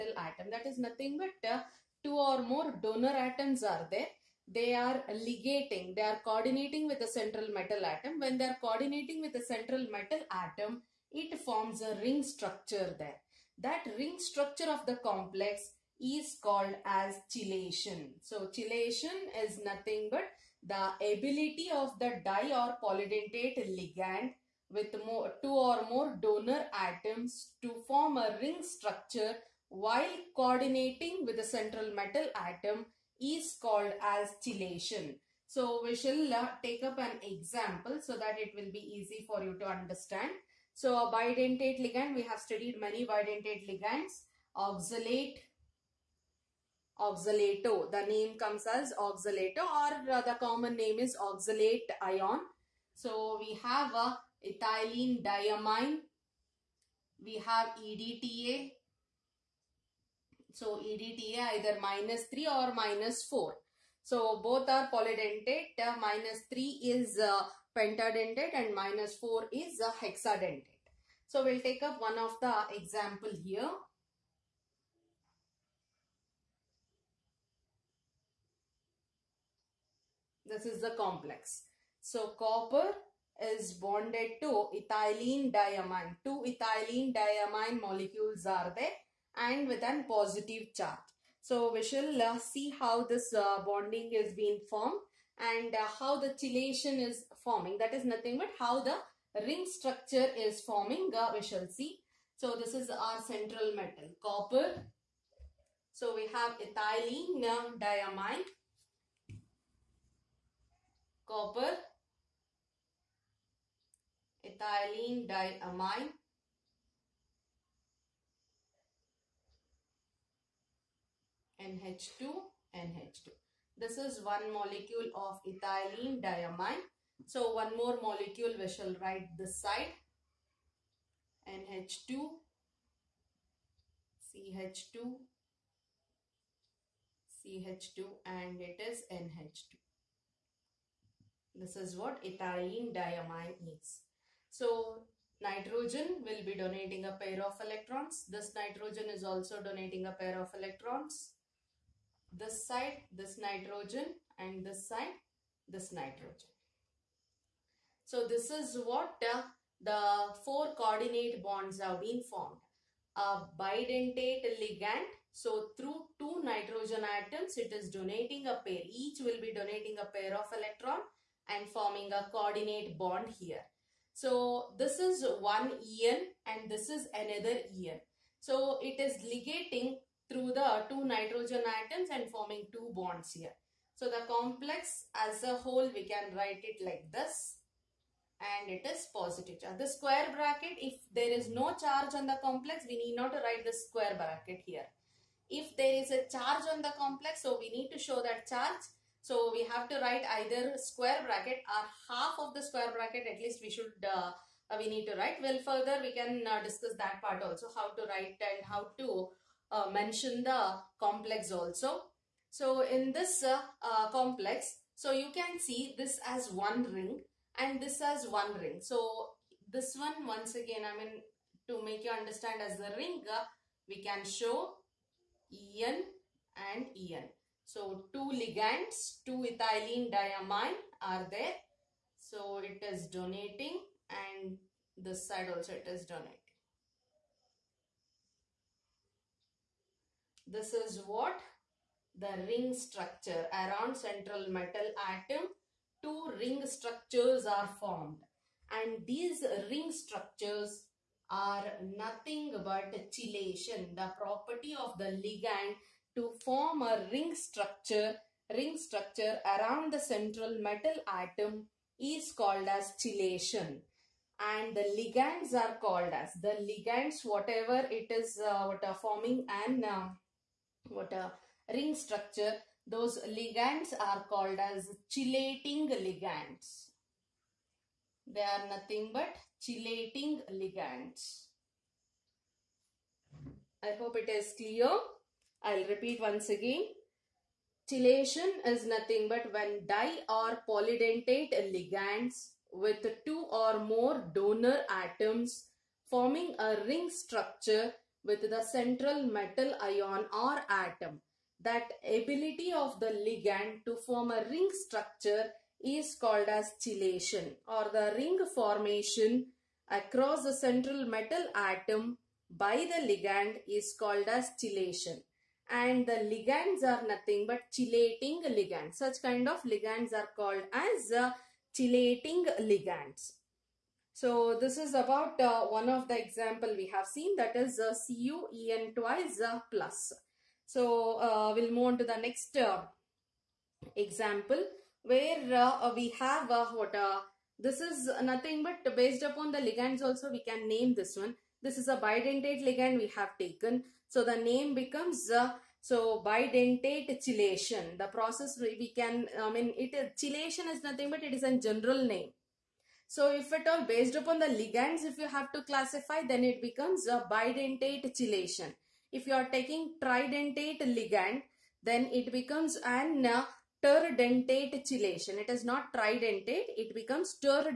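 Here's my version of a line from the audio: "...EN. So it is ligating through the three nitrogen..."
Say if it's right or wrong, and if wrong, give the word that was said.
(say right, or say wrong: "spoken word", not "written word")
wrong: "two", not "three".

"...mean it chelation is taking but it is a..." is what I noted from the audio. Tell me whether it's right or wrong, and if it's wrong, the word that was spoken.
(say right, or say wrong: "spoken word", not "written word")
wrong: "nothing", not "taking".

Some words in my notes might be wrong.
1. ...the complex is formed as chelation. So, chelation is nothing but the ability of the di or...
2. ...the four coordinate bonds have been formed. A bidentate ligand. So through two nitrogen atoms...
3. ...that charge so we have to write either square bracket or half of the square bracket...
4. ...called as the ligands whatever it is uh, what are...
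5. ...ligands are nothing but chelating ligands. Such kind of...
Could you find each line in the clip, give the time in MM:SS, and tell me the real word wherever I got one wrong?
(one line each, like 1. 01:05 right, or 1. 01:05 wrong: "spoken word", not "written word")
1. 00:14 wrong: "called", not "formed"
2. 02:39 right
3. 03:18 right
4. 04:25 right
5. 05:16 right.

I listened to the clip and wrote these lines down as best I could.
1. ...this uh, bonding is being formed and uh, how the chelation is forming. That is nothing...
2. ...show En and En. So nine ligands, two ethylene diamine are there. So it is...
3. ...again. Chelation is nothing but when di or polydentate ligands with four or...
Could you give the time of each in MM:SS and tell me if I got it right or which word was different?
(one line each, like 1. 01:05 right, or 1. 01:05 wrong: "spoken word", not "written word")
1. 01:33 right
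2. 03:44 wrong: "two", not "nine"
3. 04:46 wrong: "two", not "four".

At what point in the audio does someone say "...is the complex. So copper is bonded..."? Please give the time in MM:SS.
01:20.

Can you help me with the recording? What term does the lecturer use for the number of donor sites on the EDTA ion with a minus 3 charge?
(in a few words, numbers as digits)
pentadentate.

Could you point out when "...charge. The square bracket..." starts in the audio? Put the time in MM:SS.
03:09.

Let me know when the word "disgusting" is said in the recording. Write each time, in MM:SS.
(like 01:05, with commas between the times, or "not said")
not said.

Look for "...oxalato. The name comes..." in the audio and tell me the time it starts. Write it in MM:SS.
00:47.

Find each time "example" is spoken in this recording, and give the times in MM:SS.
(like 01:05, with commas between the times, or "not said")
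00:37, 01:12, 05:26, 05:33.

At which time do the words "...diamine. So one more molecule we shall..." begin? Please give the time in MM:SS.
02:06.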